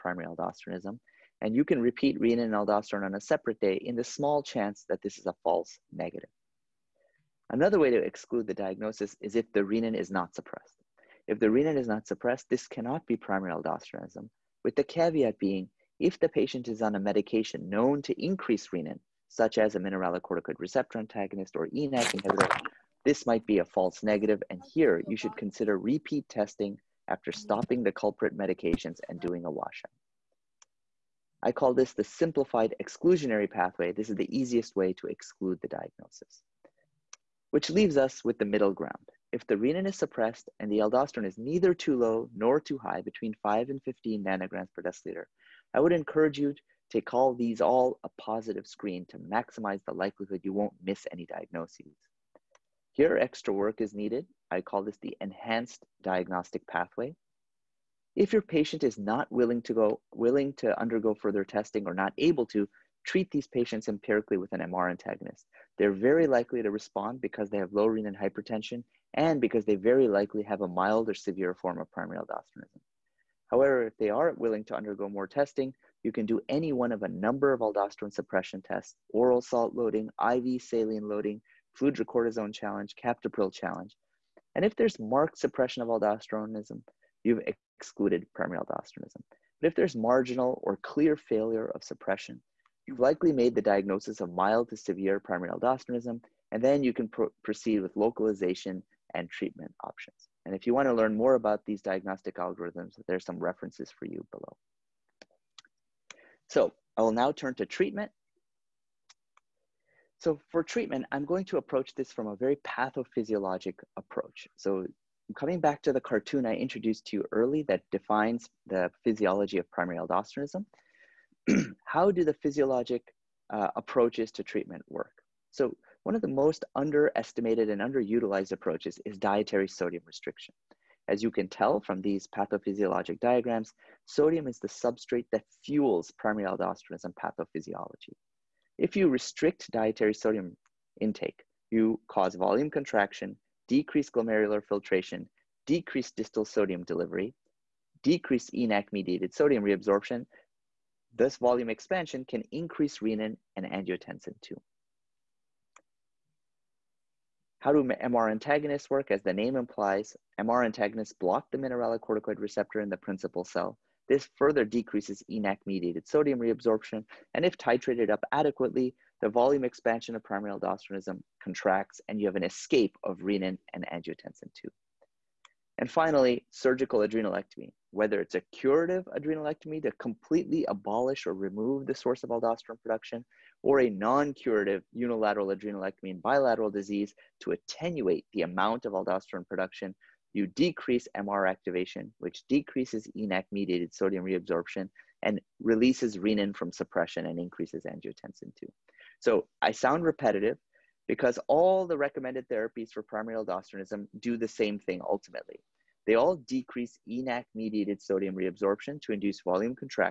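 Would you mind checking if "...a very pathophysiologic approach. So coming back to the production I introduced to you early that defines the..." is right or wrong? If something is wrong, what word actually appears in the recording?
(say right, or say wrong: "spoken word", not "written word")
wrong: "cartoon", not "production".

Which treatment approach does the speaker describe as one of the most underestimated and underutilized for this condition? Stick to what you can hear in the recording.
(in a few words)
dietary sodium restriction.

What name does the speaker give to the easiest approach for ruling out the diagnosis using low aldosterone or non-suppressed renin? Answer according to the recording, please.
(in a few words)
simplified exclusionary pathway.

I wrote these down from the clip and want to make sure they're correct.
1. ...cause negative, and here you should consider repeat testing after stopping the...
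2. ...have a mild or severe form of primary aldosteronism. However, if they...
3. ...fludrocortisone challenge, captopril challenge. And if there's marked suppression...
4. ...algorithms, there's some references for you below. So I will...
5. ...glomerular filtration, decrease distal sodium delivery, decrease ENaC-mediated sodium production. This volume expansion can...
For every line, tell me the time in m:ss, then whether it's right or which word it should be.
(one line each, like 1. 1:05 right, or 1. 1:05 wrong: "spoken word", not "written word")
1. 0:23 wrong: "false", not "cause"
2. 1:10 right
3. 1:21 right
4. 1:42 right
5. 2:24 wrong: "reabsorption", not "production".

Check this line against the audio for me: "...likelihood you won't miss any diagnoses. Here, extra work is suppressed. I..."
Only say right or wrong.
wrong.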